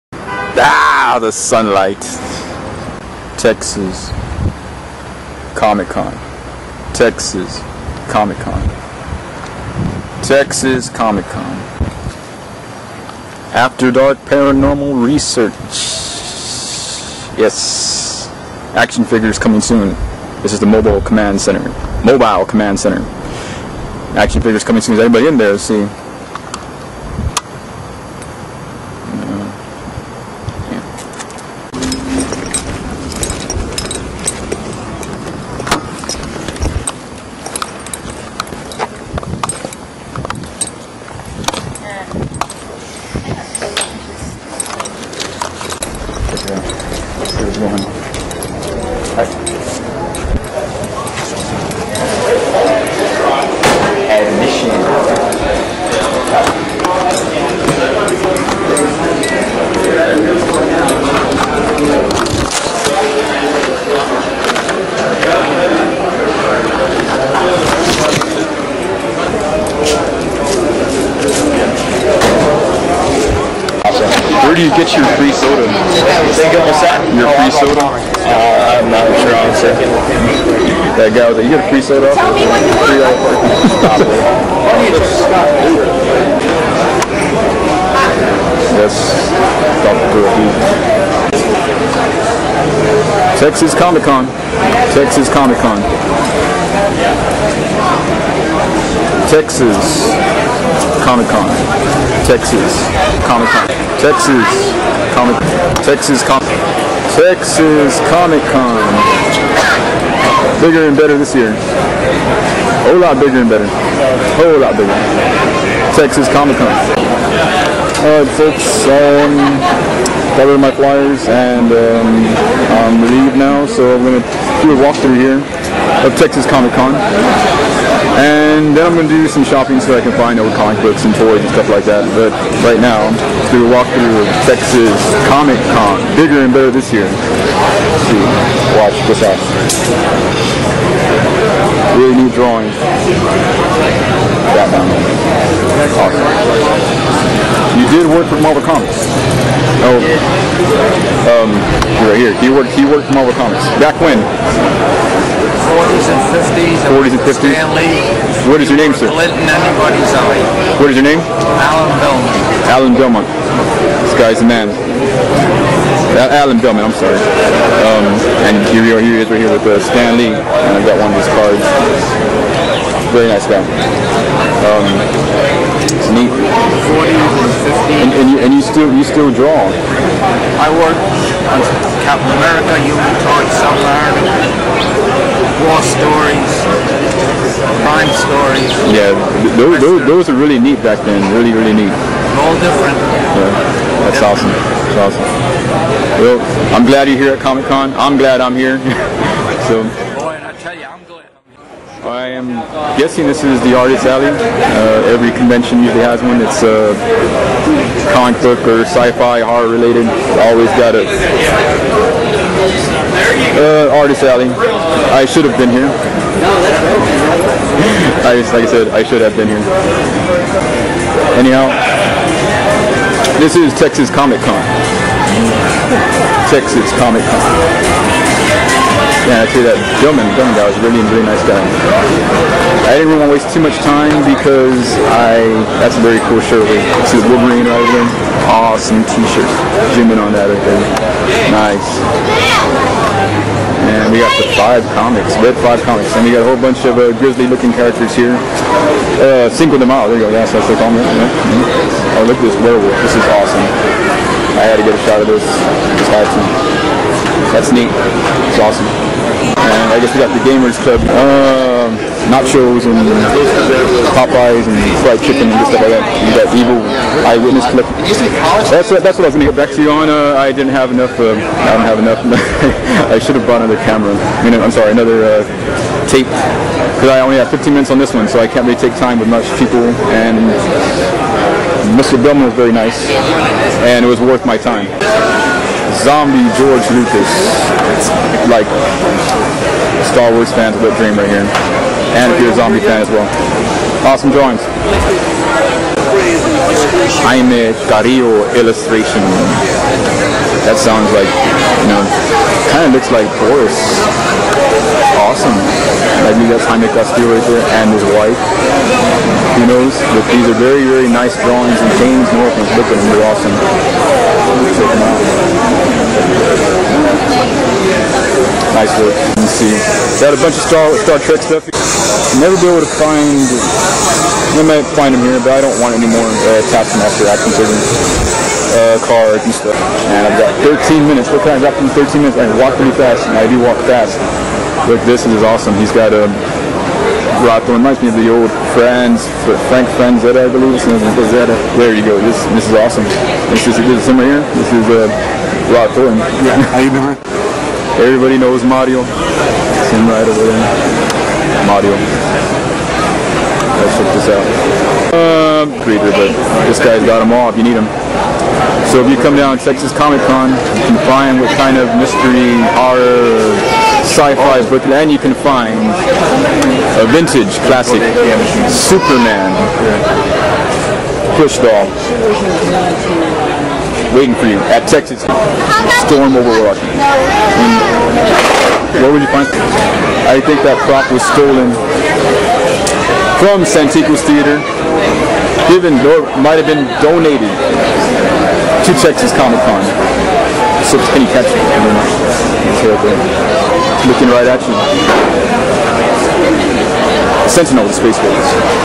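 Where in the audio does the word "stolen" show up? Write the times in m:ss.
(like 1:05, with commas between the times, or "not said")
6:21.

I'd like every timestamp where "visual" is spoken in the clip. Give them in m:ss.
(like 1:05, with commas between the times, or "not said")
not said.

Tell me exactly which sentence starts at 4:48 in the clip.
Like, Star Wars fans will dream right here.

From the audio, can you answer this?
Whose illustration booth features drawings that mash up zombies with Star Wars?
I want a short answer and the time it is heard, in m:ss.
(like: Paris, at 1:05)
Jaime Carrillo, at 4:57.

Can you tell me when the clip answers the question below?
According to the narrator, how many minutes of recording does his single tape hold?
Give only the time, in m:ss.
4:37.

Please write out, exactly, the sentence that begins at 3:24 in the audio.
Uh, every convention usually has one It's uh, comic book or sci-fi, horror related.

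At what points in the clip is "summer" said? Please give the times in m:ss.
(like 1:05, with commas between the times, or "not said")
5:44.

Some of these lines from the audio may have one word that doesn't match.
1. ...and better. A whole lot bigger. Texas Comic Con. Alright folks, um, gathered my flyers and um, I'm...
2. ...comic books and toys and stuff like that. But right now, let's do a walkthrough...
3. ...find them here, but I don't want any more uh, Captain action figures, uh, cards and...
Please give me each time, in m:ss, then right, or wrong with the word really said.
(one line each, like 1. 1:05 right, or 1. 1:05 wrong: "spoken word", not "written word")
1. 1:53 right
2. 2:10 right
3. 5:24 wrong: "Taskmaster", not "Captain".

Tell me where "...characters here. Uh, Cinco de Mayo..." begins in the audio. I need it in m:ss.
4:07.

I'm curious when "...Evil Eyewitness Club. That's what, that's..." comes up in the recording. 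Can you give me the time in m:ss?
4:26.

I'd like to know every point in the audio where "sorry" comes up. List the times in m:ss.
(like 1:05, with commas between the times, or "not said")
2:46, 4:34.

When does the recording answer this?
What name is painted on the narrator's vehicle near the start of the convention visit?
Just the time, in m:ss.
0:20.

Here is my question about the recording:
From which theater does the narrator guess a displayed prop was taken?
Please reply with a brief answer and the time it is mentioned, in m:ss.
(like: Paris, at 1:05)
Santico's Theater, at 6:20.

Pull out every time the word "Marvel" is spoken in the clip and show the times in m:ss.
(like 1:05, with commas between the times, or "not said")
2:28, 2:33.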